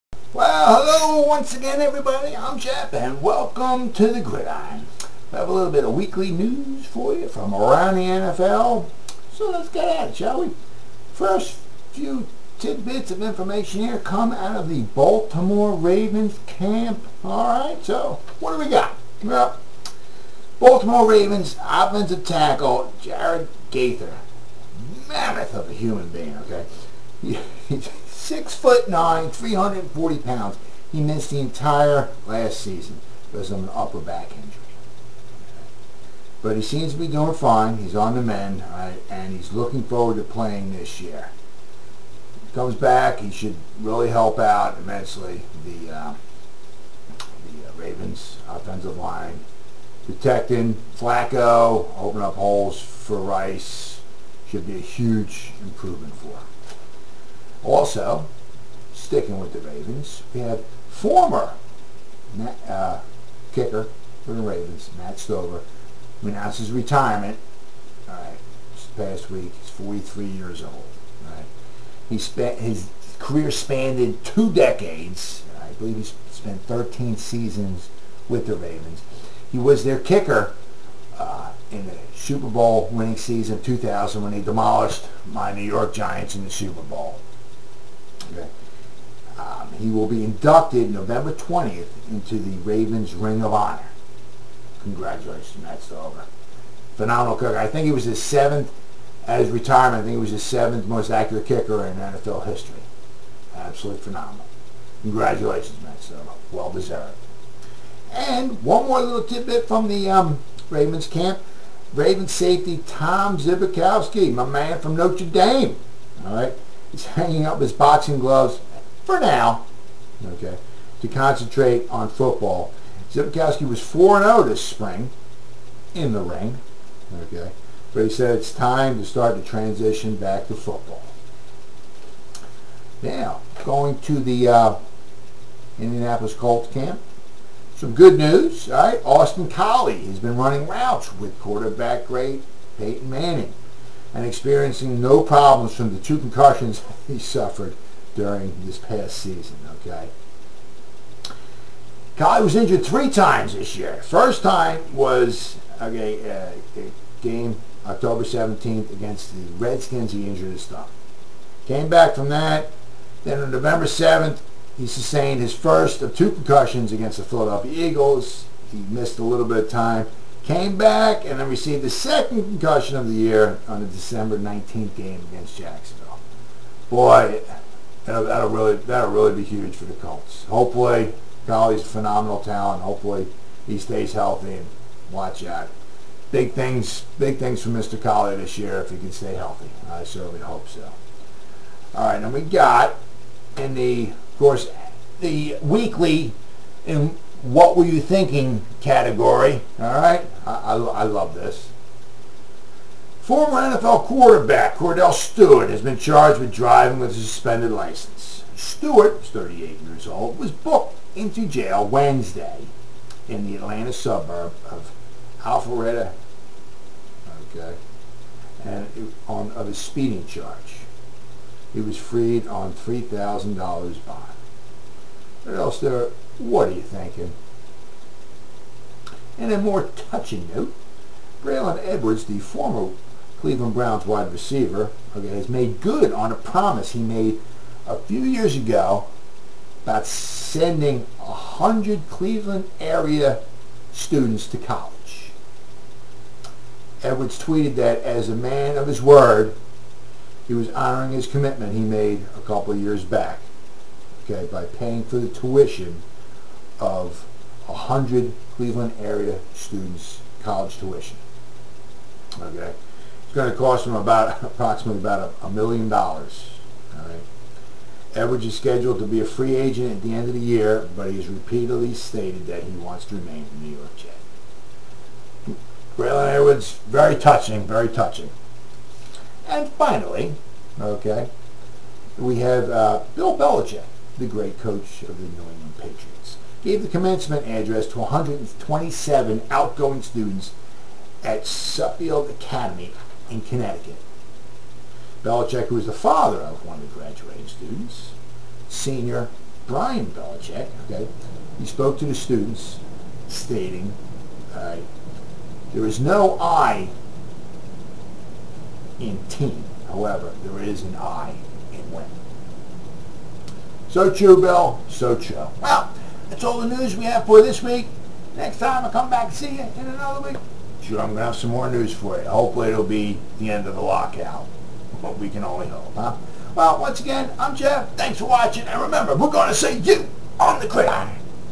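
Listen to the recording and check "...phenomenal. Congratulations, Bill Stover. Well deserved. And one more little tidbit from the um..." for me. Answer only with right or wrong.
wrong.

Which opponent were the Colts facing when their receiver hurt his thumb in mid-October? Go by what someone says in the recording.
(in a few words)
Redskins.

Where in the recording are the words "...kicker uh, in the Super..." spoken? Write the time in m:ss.
1:19.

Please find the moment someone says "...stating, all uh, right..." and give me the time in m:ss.
5:03.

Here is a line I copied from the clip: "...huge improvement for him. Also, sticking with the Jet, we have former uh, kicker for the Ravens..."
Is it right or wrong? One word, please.
wrong.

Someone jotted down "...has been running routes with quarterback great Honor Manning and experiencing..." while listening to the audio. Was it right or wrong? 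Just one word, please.
wrong.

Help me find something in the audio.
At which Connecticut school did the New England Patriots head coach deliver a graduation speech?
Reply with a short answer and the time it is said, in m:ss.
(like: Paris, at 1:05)
Suffield Academy, at 4:51.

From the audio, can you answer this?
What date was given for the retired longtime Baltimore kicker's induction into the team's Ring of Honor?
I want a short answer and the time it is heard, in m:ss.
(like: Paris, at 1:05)
November 20th, at 1:30.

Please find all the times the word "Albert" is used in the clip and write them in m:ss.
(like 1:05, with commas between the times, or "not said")
not said.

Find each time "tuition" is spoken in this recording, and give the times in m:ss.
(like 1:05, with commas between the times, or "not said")
4:15, 4:20.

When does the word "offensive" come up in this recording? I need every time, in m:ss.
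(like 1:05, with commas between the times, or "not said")
0:21, 0:48.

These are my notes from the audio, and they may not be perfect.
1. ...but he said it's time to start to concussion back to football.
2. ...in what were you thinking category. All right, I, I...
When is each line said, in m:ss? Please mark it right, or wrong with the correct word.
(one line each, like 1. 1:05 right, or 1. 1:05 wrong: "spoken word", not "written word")
1. 2:07 wrong: "transition", not "concussion"
2. 3:16 right.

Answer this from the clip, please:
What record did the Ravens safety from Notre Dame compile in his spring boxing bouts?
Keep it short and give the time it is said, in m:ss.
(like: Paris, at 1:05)
4-0, at 2:03.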